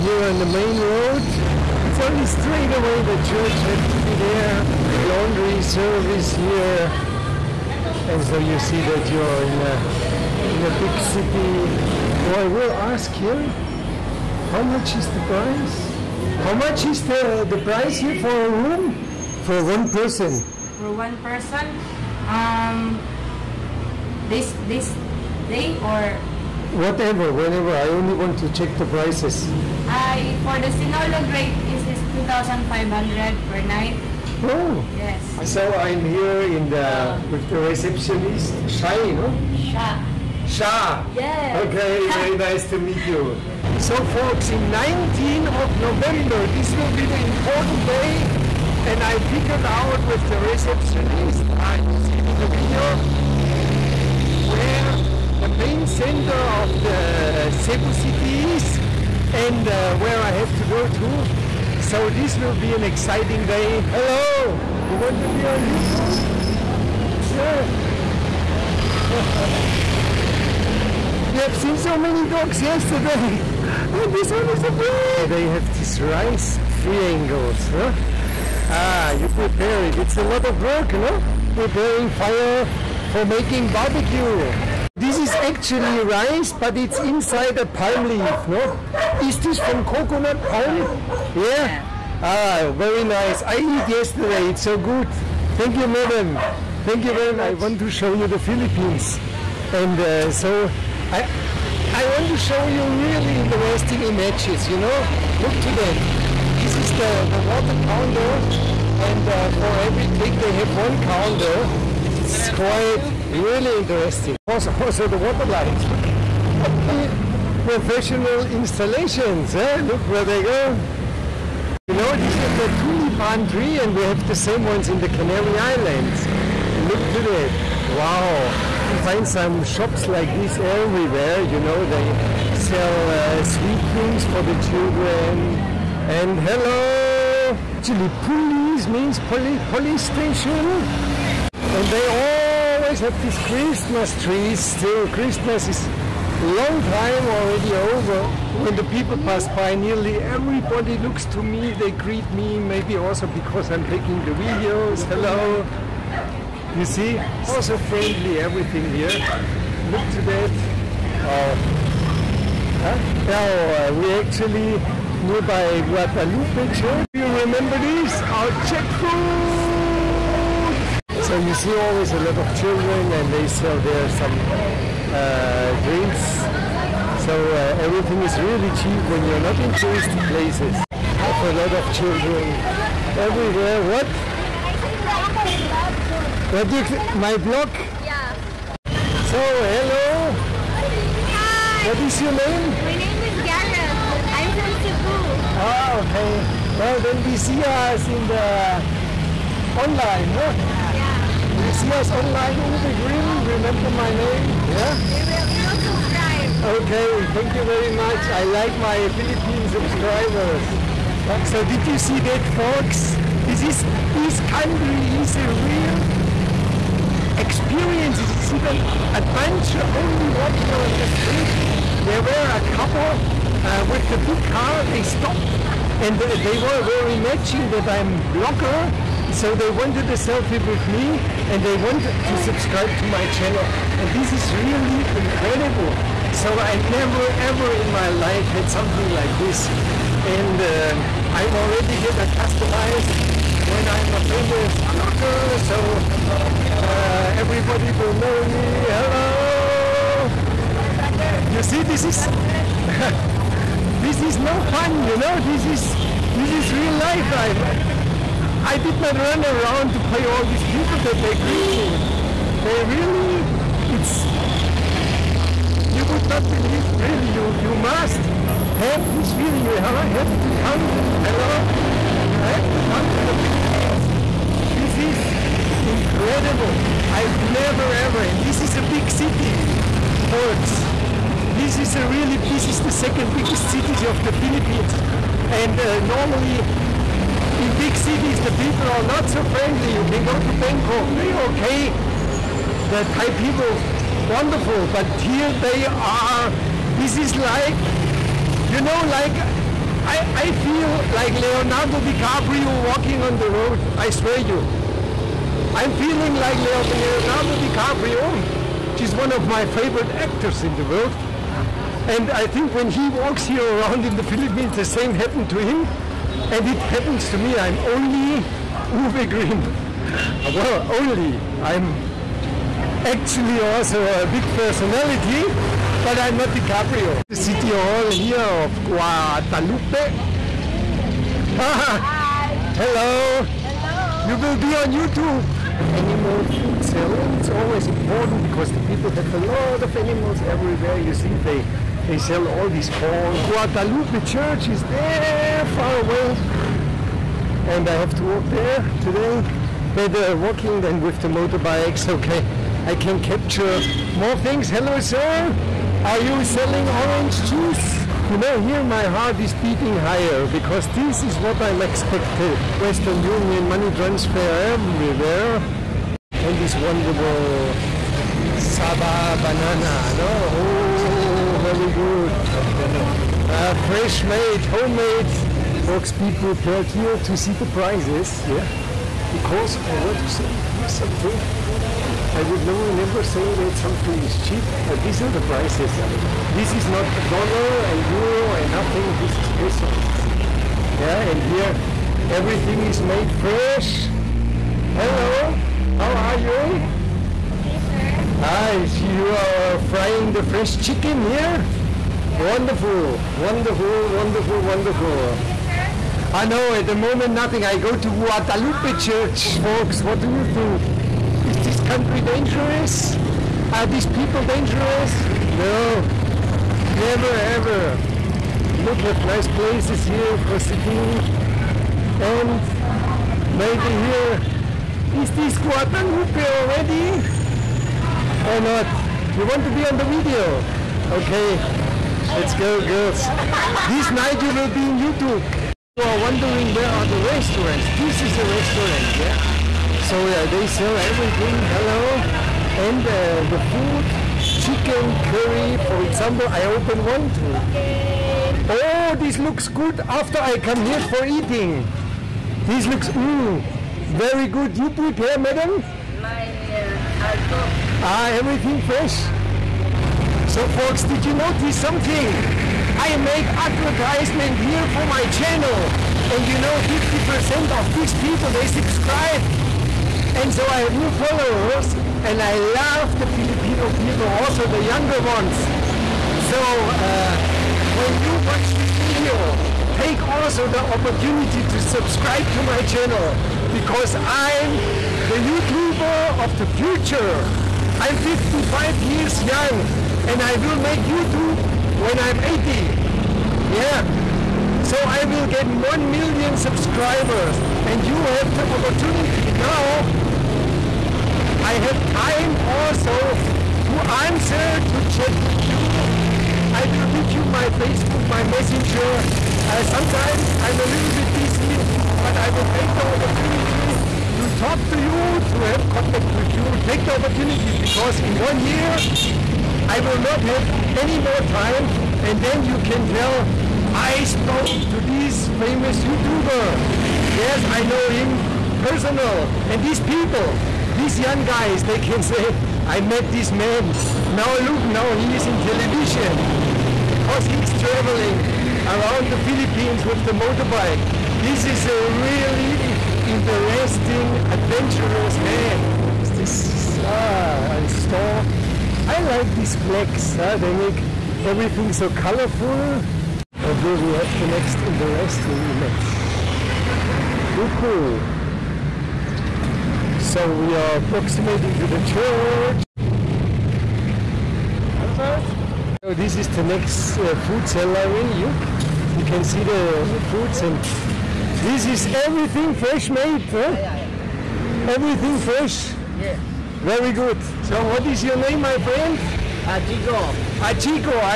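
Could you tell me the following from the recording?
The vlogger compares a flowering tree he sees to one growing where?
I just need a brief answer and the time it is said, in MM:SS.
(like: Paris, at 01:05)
Canary Islands, at 02:05.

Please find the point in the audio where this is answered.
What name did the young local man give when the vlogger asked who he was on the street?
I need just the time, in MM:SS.
03:13.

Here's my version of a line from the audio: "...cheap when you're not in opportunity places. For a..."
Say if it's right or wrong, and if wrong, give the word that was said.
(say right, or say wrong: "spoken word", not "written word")
wrong: "touristy", not "opportunity".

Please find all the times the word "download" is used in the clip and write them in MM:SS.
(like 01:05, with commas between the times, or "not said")
not said.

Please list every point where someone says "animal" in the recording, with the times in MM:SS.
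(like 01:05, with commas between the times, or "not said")
05:35, 05:39.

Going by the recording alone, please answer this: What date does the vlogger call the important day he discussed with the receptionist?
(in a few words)
19 November.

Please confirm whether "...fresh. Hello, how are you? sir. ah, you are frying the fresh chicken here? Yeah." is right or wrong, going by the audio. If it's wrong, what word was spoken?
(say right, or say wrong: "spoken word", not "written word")
right.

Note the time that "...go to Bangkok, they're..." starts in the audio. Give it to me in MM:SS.
04:50.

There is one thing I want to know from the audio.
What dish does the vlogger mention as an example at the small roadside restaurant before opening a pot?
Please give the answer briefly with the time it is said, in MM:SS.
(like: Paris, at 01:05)
Chicken curry, at 07:24.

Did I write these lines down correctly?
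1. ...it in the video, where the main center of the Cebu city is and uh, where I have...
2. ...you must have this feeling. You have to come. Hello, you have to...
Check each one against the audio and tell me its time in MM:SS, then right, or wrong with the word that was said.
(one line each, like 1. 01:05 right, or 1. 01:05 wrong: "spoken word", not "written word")
1. 00:52 right
2. 04:27 right.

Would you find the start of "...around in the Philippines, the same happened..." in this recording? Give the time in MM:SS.
05:13.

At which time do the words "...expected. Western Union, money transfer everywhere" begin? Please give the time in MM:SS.
06:01.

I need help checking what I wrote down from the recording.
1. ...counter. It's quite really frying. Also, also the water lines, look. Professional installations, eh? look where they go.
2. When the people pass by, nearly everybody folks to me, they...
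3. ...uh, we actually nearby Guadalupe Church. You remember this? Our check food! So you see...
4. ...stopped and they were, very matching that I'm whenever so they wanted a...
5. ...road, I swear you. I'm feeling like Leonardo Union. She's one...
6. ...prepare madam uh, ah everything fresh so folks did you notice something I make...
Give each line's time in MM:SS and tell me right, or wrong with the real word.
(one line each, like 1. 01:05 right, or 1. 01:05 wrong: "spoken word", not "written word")
1. 01:51 wrong: "interesting", not "frying"
2. 02:28 wrong: "looks", not "folks"
3. 02:43 right
4. 03:45 wrong: "blogger", not "whenever"
5. 05:03 wrong: "DiCaprio", not "Union"
6. 07:34 right.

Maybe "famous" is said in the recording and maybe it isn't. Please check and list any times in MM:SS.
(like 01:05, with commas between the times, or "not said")
04:04, 08:45.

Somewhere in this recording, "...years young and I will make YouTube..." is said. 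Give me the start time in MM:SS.
08:09.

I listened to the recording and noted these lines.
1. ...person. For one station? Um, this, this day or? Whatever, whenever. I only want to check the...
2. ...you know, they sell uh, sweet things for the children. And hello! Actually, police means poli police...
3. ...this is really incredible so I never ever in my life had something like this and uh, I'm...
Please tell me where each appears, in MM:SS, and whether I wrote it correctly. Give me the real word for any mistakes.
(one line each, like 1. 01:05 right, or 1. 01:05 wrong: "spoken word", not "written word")
1. 00:19 wrong: "person", not "station"
2. 02:11 right
3. 03:54 right.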